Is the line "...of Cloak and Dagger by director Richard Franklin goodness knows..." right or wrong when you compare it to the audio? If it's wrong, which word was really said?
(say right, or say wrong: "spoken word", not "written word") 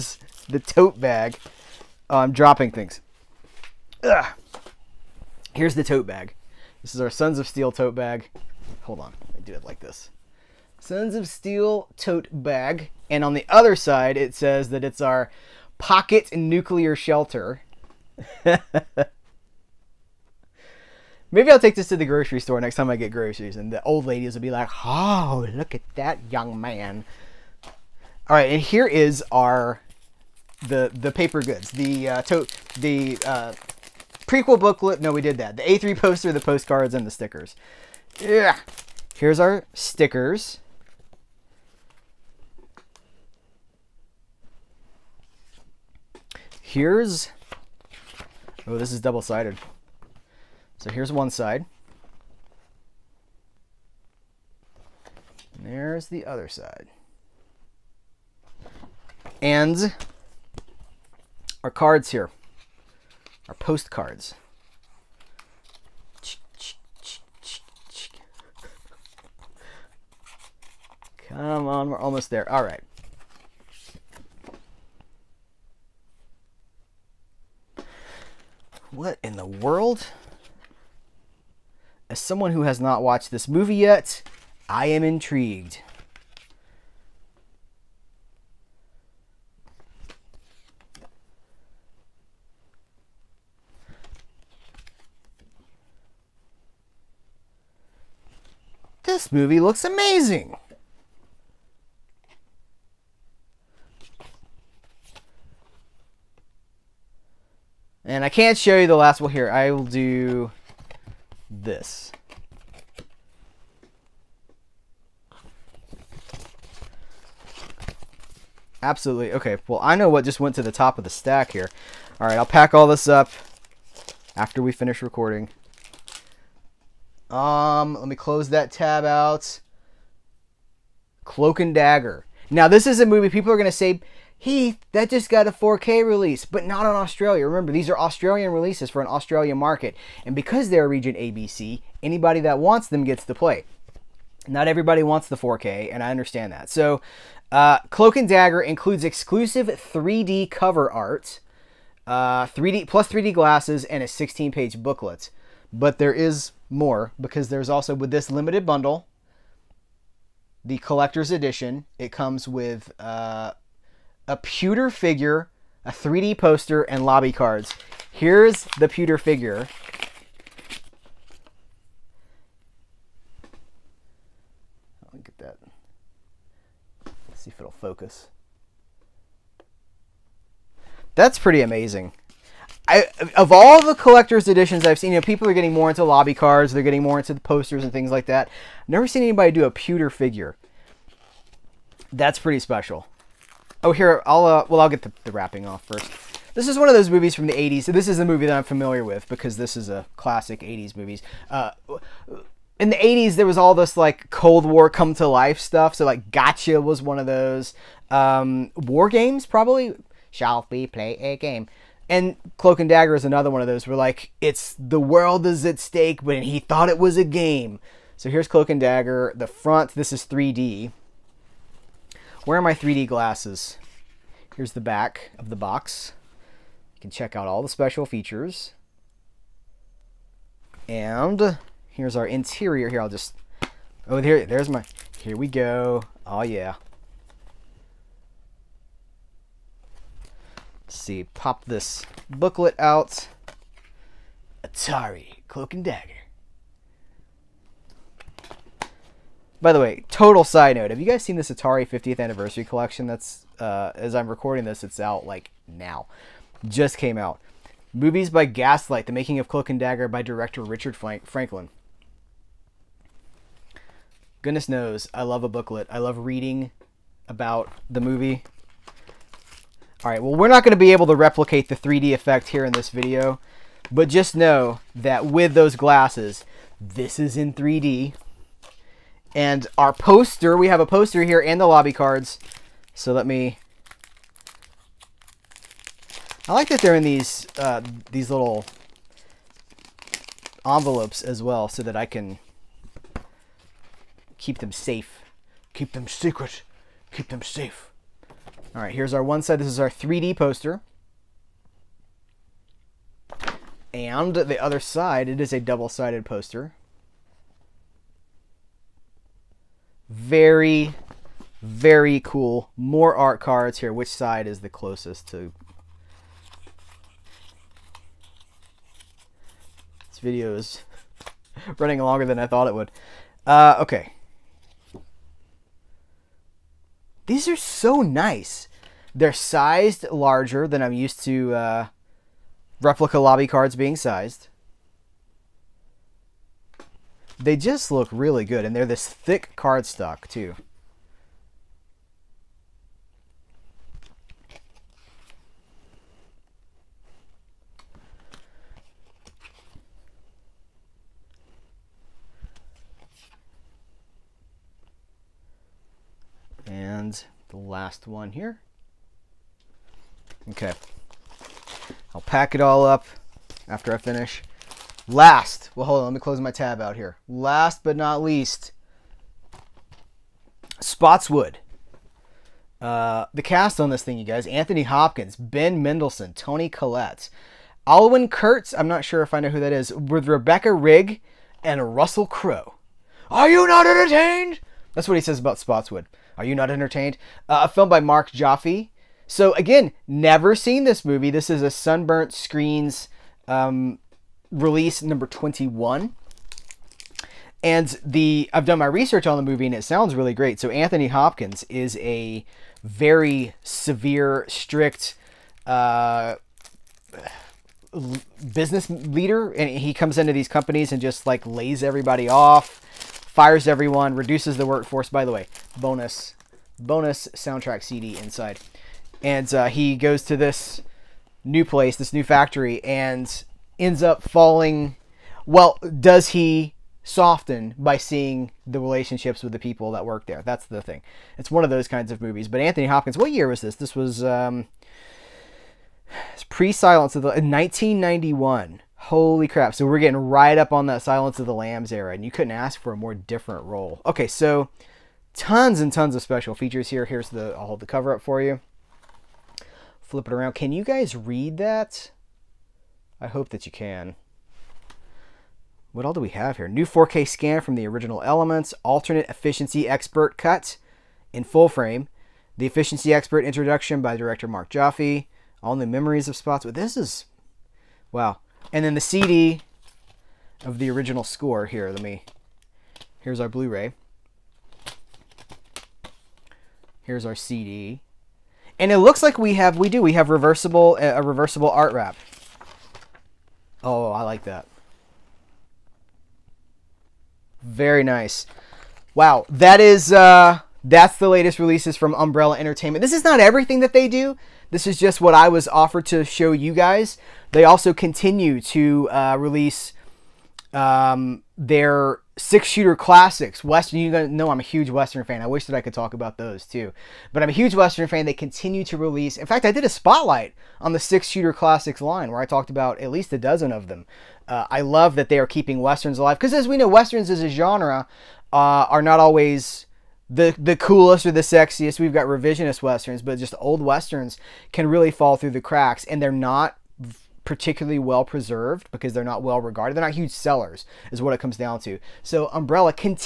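right.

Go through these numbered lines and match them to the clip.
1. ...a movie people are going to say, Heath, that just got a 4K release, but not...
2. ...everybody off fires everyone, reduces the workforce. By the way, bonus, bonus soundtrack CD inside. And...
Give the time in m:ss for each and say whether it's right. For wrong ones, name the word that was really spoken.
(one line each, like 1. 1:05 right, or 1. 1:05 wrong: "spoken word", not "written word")
1. 2:12 right
2. 6:51 right.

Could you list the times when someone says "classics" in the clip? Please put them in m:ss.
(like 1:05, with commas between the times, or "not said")
3:20, 8:22, 8:31.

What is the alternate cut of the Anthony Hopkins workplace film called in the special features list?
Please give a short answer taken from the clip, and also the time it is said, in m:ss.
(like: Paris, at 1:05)
efficiency expert cut, at 7:39.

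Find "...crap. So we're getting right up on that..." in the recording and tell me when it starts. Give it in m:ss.
7:19.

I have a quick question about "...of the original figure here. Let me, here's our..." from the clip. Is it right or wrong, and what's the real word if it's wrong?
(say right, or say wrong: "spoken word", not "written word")
wrong: "score", not "figure".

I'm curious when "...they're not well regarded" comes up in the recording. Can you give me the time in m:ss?
8:49.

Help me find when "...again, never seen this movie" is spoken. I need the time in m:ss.
6:29.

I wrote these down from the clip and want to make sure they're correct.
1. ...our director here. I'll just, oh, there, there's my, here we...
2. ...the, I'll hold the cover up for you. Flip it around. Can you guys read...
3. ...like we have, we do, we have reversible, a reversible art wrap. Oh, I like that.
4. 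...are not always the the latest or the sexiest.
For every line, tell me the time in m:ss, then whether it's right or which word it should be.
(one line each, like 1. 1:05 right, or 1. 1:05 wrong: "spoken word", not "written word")
1. 3:52 wrong: "interior", not "director"
2. 7:27 right
3. 7:59 right
4. 8:38 wrong: "coolest", not "latest".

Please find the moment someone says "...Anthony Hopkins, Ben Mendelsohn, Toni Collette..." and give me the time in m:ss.
6:14.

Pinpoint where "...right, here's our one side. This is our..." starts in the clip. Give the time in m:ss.
4:58.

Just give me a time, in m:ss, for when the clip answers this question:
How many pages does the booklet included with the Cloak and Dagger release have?
2:34.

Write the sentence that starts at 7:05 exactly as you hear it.
Well, does he soften by seeing the relationships with the people that work there?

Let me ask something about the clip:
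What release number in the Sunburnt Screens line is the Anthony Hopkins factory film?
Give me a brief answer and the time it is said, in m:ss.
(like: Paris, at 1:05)
21, at 6:35.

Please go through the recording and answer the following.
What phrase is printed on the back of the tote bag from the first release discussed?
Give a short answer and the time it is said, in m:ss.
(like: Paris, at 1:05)
pocket nuclear shelter, at 0:15.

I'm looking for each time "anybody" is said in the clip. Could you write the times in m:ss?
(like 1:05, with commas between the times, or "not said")
2:22, 3:09.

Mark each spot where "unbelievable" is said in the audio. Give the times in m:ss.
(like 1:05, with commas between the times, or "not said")
not said.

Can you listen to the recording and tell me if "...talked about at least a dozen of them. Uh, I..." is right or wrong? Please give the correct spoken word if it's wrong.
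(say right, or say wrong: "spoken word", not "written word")
right.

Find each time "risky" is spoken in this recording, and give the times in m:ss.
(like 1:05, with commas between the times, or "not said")
not said.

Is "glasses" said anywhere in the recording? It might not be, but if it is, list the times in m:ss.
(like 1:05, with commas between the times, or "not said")
2:33, 3:43, 4:35.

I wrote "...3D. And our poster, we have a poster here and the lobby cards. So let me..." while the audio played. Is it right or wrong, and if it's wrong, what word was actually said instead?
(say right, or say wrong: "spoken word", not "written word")
right.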